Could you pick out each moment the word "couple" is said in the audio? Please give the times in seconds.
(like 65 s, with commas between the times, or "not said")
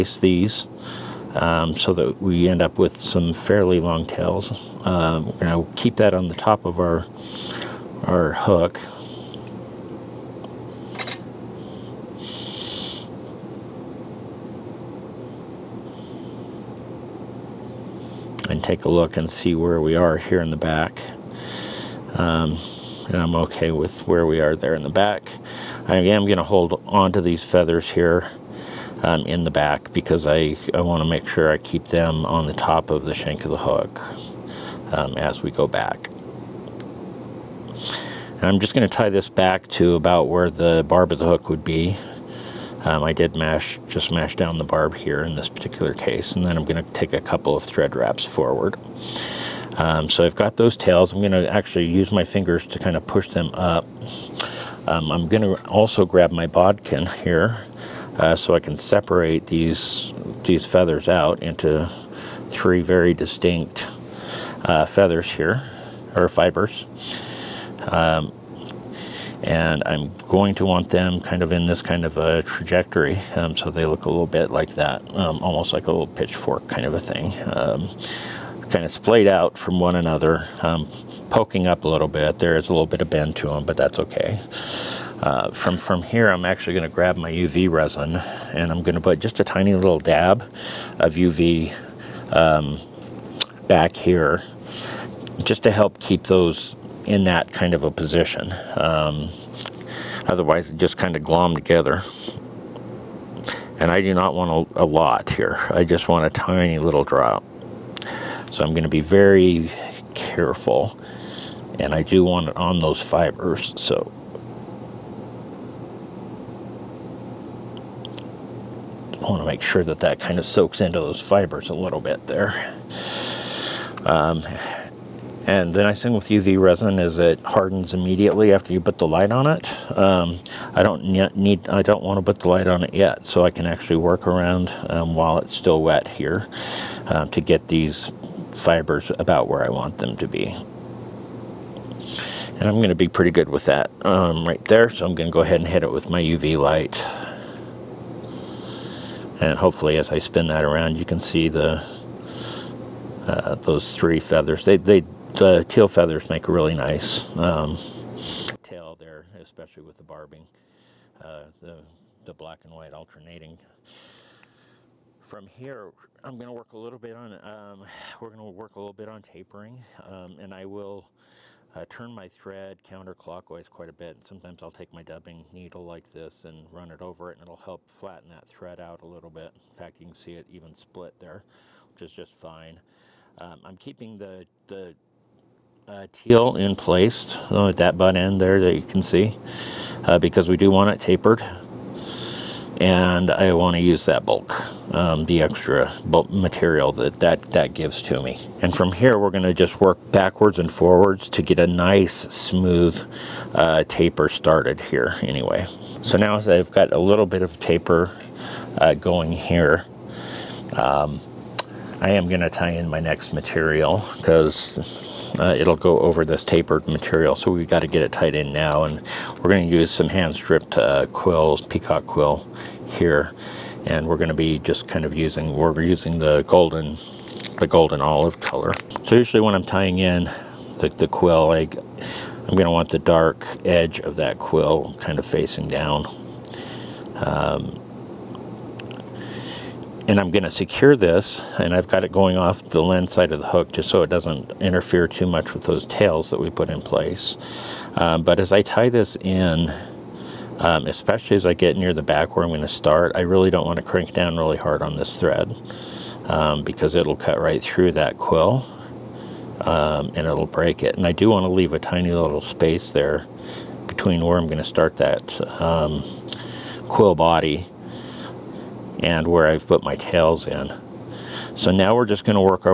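47 s.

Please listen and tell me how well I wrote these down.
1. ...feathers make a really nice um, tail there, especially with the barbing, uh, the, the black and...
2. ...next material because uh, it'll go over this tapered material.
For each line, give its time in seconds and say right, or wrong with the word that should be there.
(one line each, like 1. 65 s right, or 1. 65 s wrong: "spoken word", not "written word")
1. 155 s right
2. 213 s right.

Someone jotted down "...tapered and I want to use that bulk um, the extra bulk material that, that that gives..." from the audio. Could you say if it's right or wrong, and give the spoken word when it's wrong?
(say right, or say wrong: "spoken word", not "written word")
right.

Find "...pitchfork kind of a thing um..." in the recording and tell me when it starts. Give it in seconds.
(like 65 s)
76 s.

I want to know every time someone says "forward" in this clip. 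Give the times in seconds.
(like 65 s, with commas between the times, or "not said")
48 s, 200 s.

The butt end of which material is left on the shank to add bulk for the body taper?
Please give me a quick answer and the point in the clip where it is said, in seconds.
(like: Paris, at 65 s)
teal, at 186 s.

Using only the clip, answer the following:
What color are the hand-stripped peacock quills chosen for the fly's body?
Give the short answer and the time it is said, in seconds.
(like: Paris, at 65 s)
golden olive, at 227 s.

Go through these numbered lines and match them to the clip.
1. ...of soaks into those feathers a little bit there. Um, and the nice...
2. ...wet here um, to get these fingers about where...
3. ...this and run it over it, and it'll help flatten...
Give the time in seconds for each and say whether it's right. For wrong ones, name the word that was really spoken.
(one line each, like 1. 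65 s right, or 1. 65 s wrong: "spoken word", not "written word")
1. 120 s wrong: "fibers", not "feathers"
2. 135 s wrong: "fibers", not "fingers"
3. 176 s right.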